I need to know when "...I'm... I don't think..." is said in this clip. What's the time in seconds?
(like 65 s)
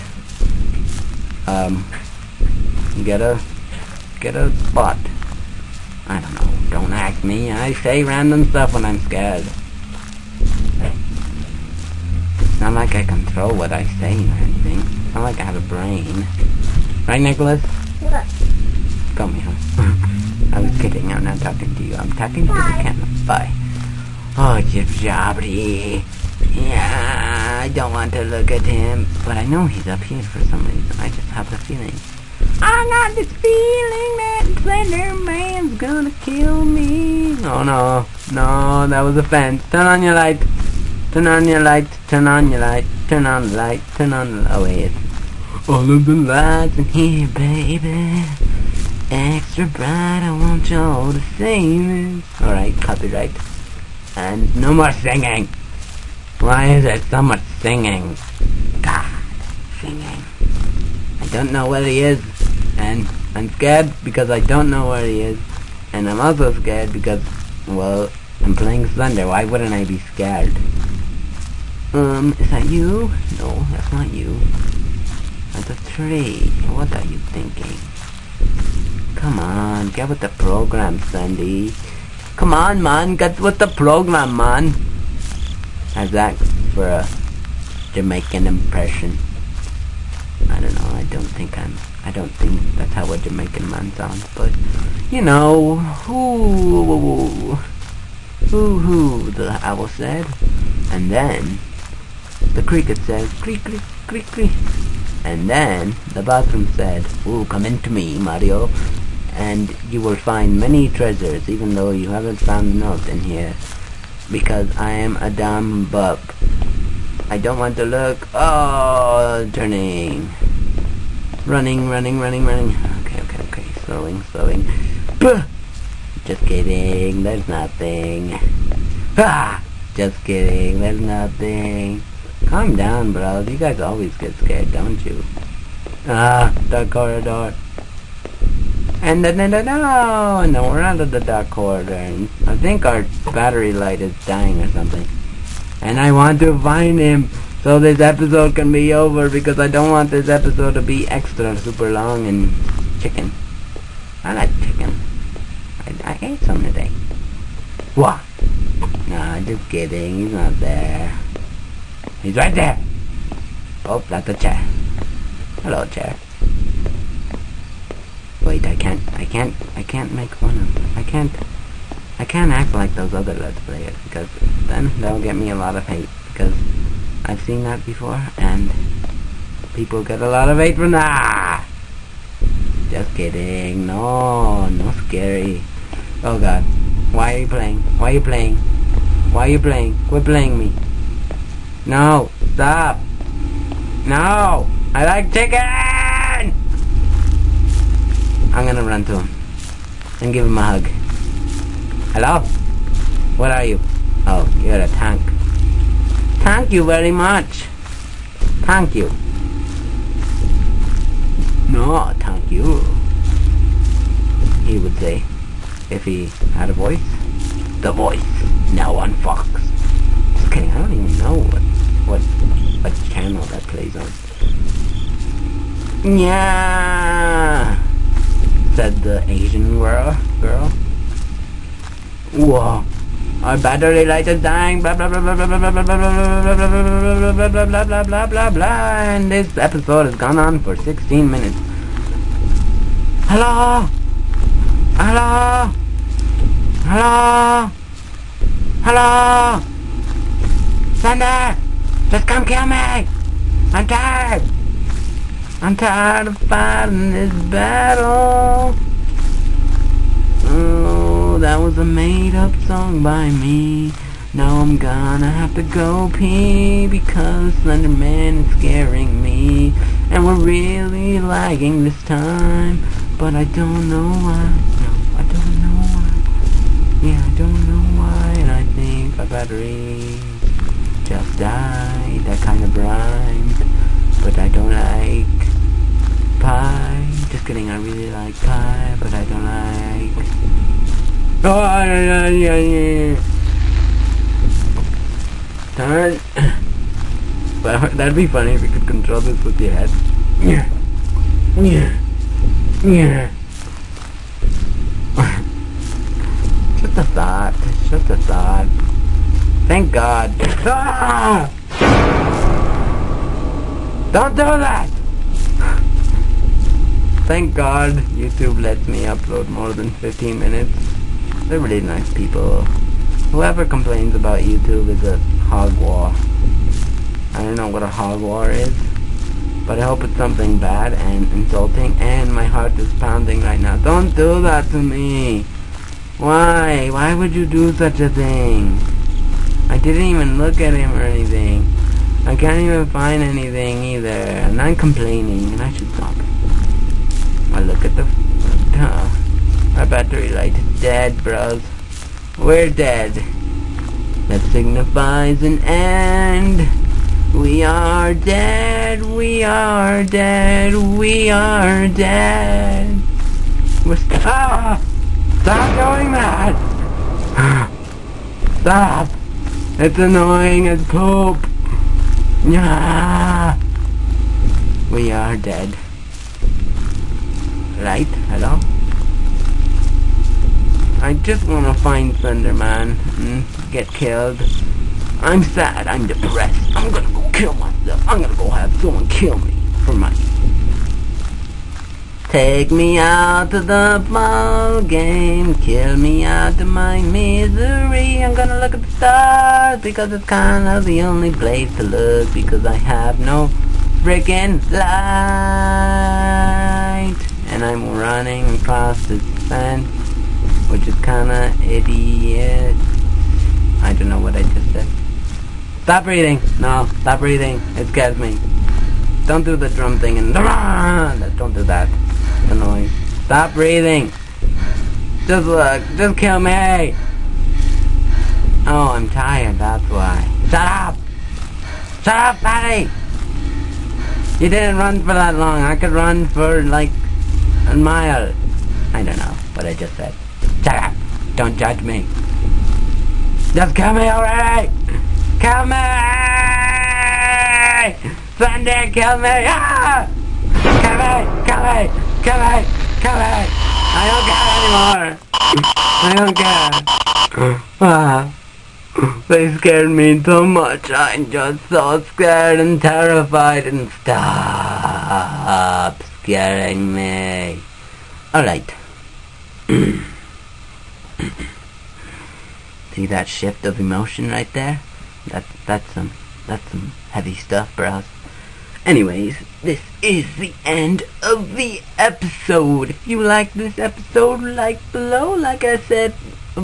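91 s.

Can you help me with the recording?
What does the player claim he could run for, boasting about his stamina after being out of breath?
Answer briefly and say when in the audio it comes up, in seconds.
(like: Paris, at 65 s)
a mile, at 435 s.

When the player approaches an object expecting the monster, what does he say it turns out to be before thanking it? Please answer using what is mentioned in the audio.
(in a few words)
a tank.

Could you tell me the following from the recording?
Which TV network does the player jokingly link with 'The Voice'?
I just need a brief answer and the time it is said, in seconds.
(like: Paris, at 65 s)
Fox, at 217 s.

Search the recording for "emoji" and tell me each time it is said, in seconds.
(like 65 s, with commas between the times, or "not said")
not said.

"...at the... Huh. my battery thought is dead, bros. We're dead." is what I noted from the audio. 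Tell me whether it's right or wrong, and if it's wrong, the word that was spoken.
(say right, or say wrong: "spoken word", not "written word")
wrong: "light", not "thought".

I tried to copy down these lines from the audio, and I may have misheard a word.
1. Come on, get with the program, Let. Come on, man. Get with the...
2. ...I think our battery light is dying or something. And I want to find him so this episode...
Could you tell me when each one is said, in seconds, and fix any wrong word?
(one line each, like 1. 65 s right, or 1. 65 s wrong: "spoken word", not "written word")
1. 79 s wrong: "Sandy", not "Let"
2. 142 s right.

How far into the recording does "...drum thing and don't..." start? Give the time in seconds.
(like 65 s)
419 s.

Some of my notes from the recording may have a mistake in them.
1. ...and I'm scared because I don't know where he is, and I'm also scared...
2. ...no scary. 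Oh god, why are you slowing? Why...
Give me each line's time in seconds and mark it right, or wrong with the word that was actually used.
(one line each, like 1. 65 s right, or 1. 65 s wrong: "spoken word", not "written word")
1. 62 s right
2. 184 s wrong: "playing", not "slowing".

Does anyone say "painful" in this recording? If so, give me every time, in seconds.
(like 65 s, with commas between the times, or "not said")
not said.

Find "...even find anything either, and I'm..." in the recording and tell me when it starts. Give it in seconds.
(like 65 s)
342 s.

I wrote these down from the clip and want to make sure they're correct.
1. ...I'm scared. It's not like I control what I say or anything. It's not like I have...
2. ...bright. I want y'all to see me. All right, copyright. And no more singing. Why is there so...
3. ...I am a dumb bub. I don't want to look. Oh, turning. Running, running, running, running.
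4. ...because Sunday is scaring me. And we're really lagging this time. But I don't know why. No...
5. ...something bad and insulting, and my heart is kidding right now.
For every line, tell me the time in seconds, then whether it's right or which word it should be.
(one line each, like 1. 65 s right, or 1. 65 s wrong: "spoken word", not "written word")
1. 8 s right
2. 49 s right
3. 114 s right
4. 266 s wrong: "Slenderman", not "Sunday"
5. 330 s wrong: "pounding", not "kidding".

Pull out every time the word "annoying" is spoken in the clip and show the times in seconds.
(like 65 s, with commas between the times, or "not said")
369 s, 422 s.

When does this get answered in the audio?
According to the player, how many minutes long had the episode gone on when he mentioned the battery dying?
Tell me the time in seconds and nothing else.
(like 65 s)
239 s.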